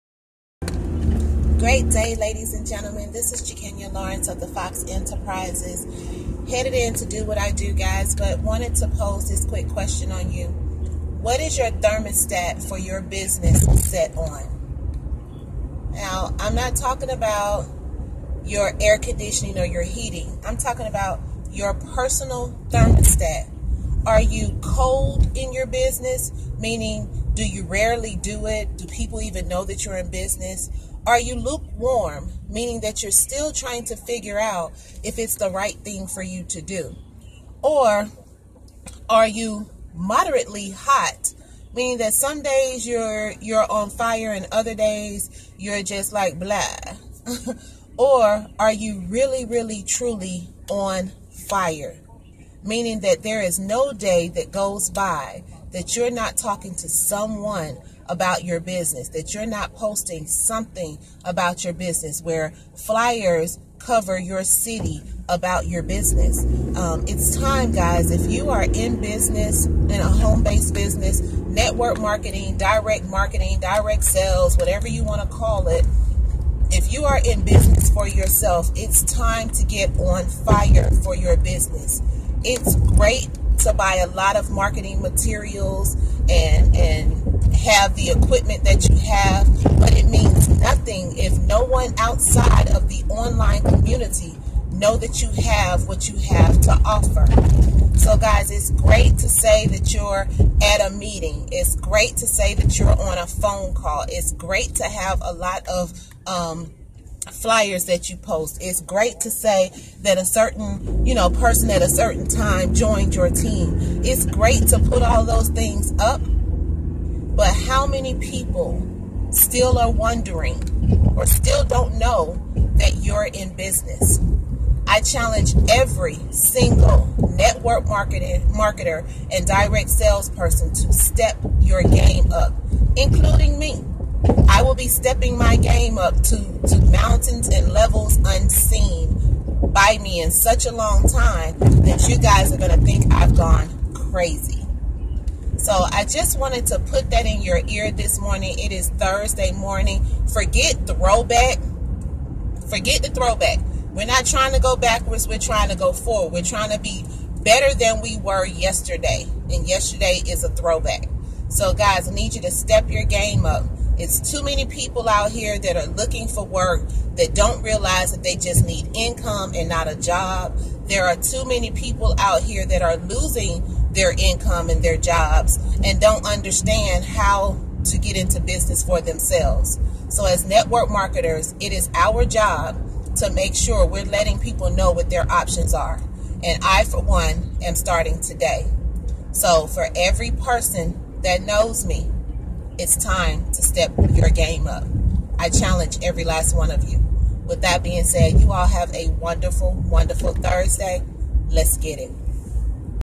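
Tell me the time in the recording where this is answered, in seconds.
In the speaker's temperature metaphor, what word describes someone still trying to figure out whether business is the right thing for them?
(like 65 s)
31 s.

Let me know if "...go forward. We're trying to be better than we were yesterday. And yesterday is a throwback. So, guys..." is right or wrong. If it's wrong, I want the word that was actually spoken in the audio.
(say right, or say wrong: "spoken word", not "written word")
right.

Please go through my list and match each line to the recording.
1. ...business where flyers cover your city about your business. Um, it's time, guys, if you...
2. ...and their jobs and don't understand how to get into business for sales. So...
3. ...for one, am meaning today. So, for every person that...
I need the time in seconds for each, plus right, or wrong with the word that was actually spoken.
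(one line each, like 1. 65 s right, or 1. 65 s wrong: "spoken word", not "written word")
1. 61 s right
2. 174 s wrong: "themselves", not "sales"
3. 186 s wrong: "starting", not "meaning".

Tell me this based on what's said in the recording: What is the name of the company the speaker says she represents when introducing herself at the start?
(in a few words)
Fox Enterprises.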